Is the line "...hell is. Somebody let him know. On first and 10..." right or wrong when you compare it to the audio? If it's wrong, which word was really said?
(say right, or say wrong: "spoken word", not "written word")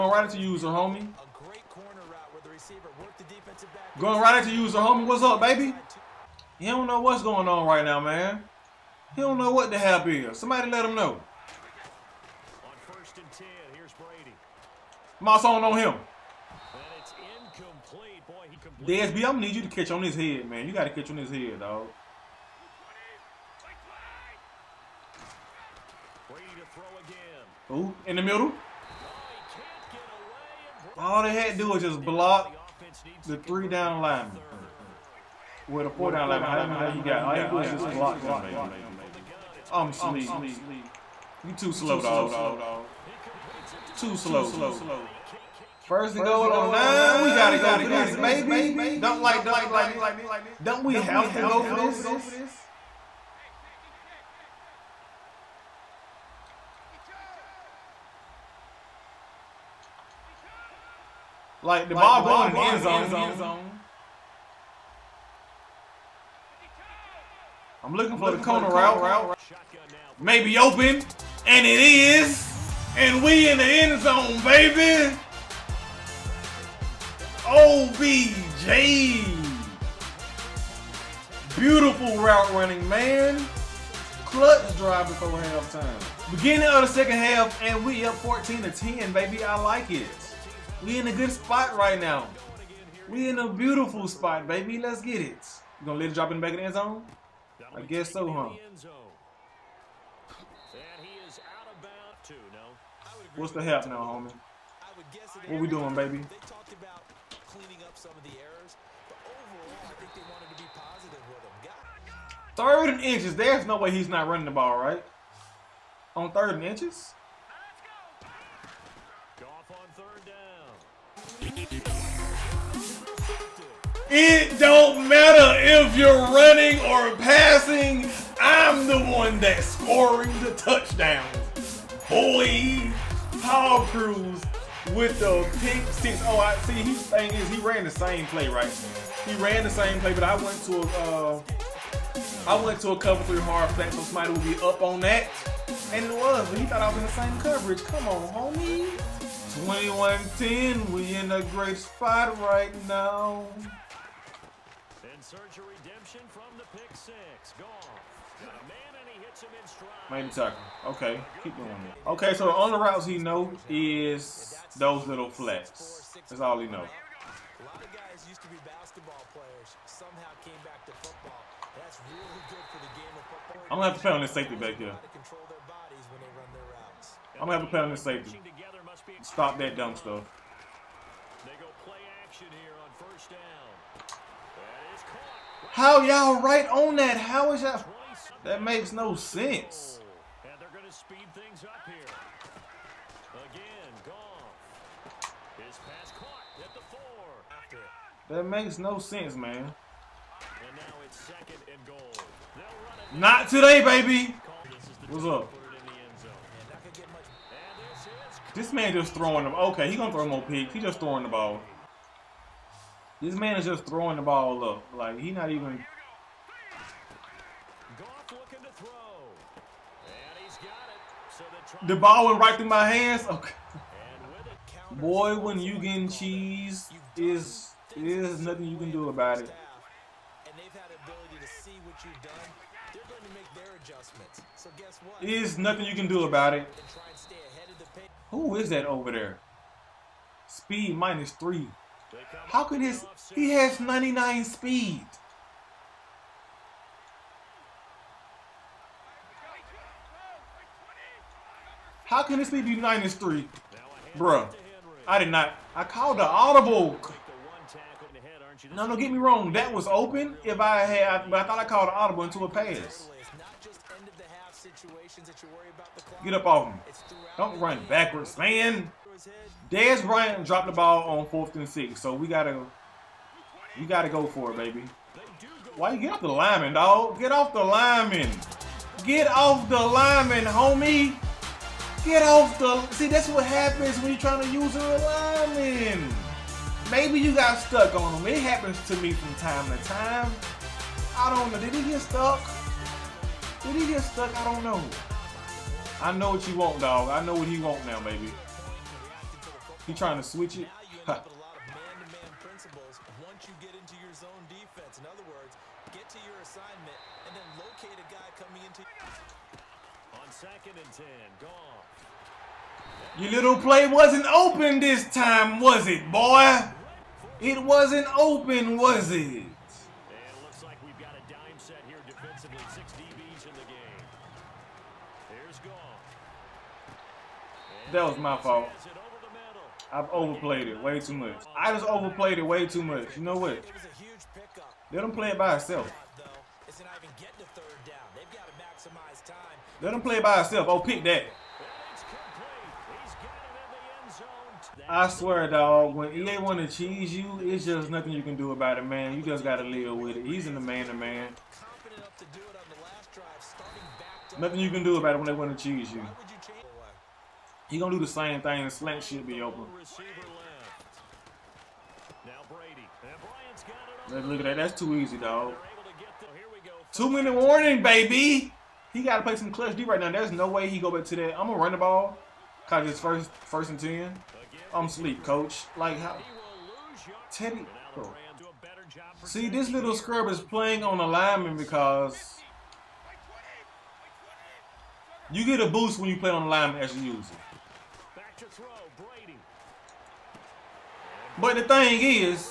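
right.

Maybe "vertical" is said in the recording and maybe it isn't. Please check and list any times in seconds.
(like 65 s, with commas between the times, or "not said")
not said.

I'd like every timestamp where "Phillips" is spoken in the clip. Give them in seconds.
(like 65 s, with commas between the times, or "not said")
not said.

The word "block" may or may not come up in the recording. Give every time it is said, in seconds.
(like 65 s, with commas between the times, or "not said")
32 s, 37 s.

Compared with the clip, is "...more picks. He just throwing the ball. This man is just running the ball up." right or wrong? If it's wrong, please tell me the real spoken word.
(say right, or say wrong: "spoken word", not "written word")
wrong: "throwing", not "running".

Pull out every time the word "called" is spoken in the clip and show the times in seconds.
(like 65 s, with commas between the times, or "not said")
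255 s, 261 s.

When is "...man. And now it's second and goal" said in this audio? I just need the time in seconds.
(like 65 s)
199 s.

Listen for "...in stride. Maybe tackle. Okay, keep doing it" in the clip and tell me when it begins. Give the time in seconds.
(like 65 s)
159 s.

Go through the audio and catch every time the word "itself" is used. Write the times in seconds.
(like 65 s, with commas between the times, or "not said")
335 s, 340 s.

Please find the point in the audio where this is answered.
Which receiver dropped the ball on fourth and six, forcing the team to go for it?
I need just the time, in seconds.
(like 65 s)
269 s.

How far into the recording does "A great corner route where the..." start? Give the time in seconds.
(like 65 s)
1 s.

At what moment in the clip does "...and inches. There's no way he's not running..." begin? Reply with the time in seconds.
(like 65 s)
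112 s.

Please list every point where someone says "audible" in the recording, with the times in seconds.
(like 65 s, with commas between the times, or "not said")
256 s, 261 s.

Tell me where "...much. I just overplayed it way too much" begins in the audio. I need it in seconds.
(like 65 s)
331 s.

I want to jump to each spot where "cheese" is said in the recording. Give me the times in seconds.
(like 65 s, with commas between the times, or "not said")
226 s, 346 s, 355 s.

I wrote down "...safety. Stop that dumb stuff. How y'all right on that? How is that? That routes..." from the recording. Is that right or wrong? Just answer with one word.
wrong.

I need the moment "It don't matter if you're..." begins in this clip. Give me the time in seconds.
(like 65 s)
124 s.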